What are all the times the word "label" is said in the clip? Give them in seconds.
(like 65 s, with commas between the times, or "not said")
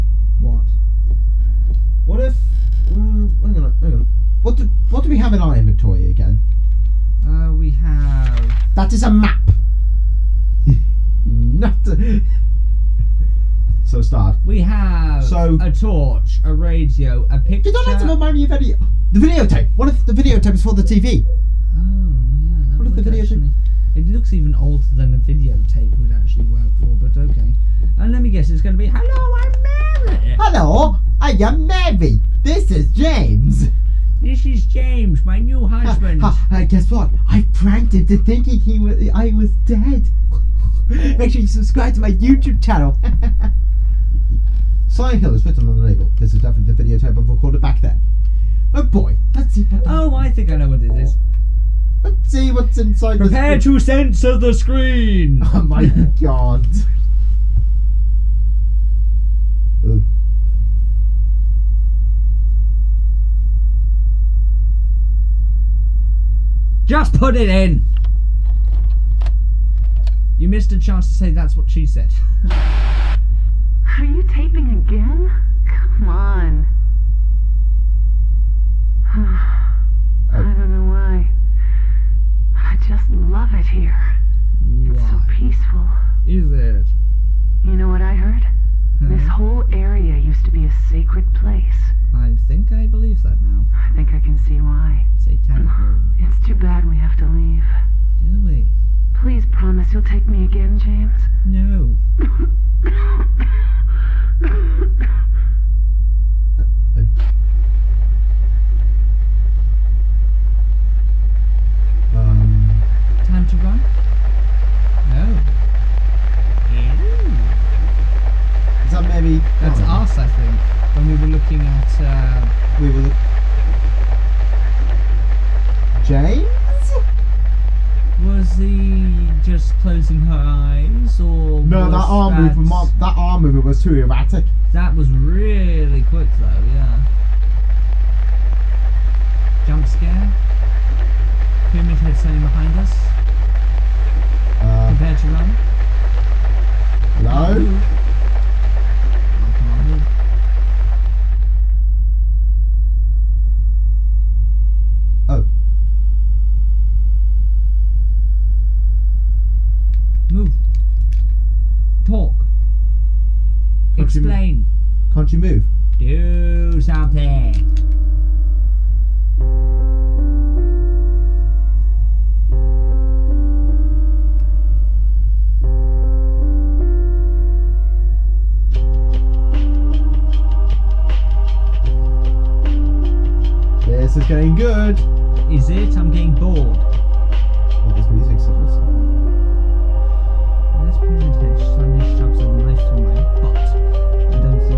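45 s.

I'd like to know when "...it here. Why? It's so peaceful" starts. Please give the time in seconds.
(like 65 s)
83 s.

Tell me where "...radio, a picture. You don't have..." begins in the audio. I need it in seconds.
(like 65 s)
16 s.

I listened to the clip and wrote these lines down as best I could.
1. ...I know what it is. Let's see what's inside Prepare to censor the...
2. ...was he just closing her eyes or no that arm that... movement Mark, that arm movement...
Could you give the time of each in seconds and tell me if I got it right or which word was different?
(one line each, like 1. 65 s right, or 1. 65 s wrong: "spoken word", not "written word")
1. 50 s right
2. 128 s right.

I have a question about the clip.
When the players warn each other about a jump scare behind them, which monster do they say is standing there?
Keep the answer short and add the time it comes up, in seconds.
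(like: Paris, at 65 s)
Pyramid Head, at 141 s.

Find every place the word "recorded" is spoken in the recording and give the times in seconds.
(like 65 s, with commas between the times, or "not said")
47 s.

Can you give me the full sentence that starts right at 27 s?
And let me guess, it's going to be Hello, I'm Mary!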